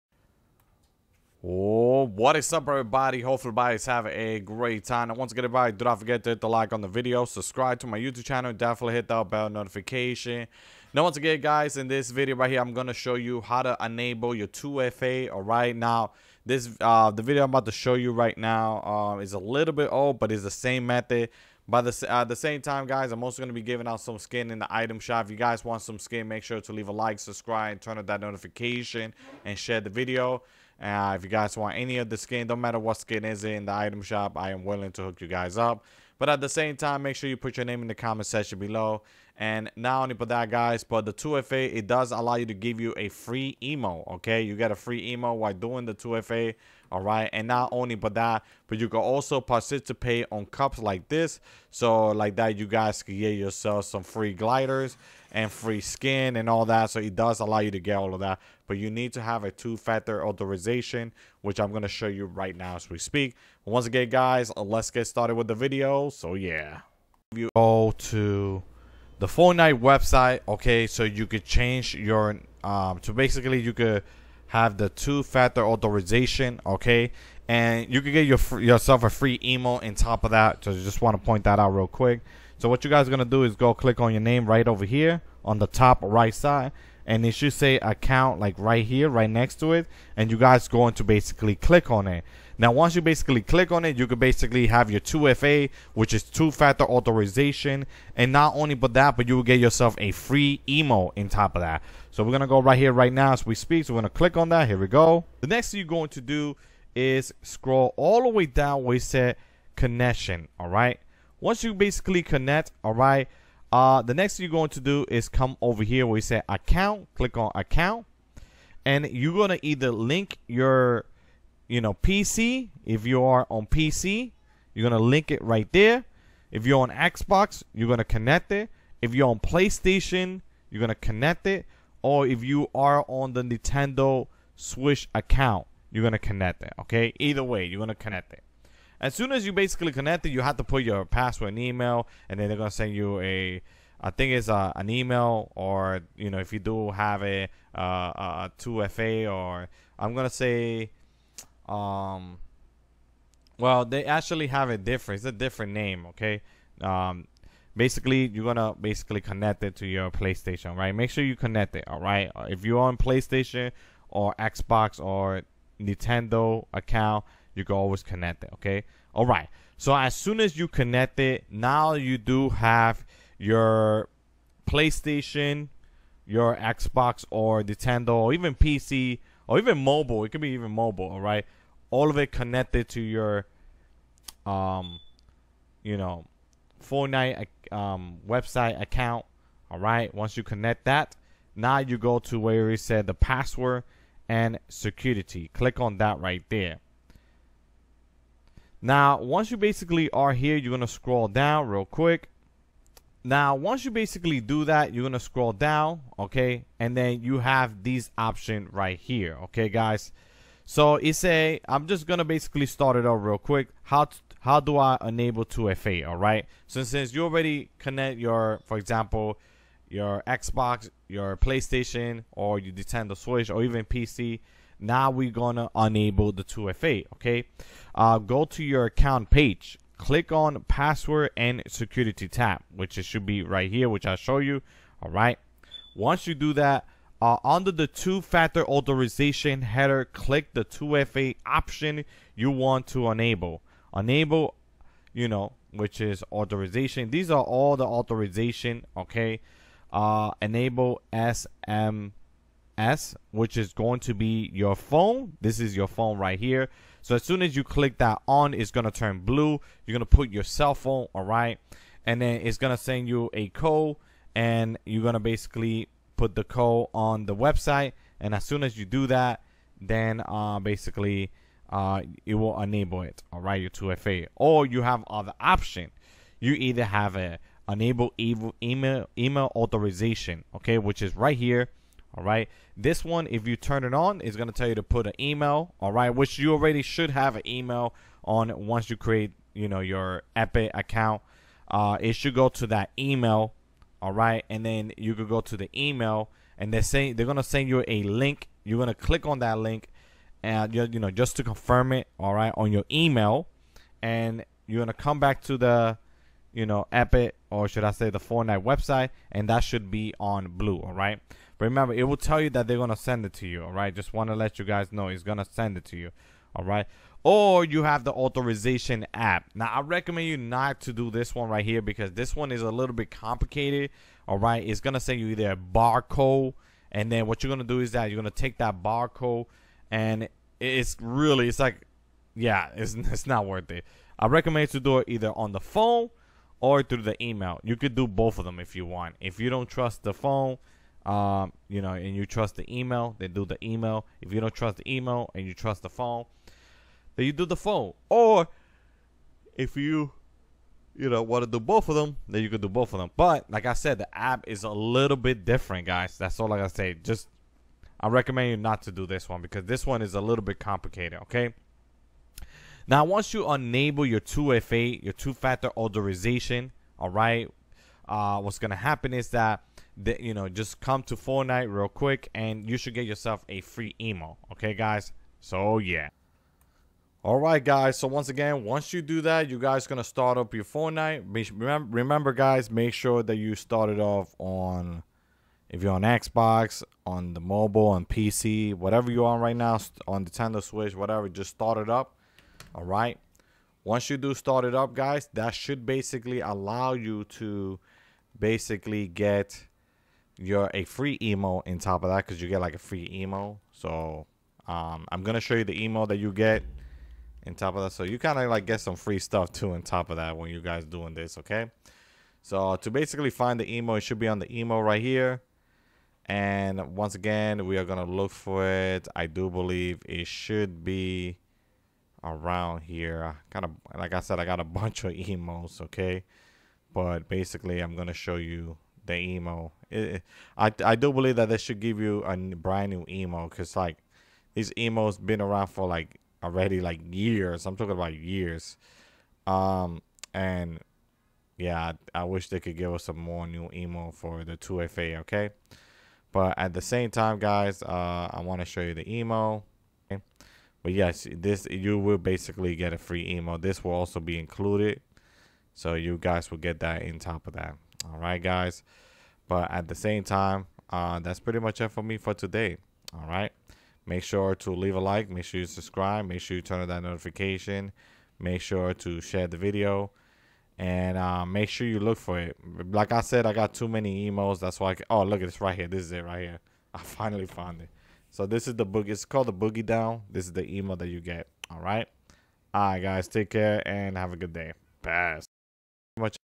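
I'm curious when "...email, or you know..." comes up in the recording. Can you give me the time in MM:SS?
02:24.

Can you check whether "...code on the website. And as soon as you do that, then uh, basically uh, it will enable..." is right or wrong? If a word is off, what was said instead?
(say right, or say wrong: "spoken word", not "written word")
right.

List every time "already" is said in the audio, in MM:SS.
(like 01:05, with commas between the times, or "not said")
03:37, 04:46, 07:16.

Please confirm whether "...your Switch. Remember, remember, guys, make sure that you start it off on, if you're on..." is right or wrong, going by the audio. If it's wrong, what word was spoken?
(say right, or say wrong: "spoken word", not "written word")
wrong: "Fortnite", not "Switch".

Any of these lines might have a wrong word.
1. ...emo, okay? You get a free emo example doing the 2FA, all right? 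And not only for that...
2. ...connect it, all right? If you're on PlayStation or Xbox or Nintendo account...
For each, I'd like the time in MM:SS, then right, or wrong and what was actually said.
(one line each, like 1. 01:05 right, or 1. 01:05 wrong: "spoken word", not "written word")
1. 00:43 wrong: "while", not "example"
2. 02:41 right.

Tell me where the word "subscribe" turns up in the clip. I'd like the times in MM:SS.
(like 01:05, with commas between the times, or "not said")
00:07, 00:27, 07:45.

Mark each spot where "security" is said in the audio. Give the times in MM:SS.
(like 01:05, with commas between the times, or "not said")
03:14, 03:51.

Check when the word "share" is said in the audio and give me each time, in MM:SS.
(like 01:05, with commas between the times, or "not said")
00:29, 07:49.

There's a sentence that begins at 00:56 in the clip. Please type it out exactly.
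So it does allow you to get all of that.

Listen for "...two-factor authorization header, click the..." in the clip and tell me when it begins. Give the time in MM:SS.
03:57.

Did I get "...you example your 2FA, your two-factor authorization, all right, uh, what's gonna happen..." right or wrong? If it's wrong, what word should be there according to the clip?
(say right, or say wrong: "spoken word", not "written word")
wrong: "enable", not "example".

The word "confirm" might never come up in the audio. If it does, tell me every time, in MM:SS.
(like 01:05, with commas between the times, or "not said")
05:01.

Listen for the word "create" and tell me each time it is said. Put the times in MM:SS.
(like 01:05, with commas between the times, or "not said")
04:48.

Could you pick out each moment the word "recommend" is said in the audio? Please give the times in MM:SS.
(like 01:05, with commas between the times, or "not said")
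05:19, 05:34, 05:58.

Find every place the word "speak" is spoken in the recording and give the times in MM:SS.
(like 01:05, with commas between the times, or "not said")
01:02, 01:43.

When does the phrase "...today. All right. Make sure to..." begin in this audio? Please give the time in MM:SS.
07:42.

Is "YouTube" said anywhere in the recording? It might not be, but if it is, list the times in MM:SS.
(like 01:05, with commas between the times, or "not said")
00:07.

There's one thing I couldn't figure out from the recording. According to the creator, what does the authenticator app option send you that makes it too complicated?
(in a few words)
A barcode.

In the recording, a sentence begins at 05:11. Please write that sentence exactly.
Remember, it will tell you that they're going to send it to you, all right?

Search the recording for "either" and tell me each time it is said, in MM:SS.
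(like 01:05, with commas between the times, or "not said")
01:59, 02:17, 04:36, 05:25, 05:35.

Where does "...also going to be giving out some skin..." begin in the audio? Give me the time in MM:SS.
00:23.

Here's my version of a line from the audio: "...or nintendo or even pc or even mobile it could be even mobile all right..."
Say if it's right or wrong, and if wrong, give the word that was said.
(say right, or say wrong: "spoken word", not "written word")
right.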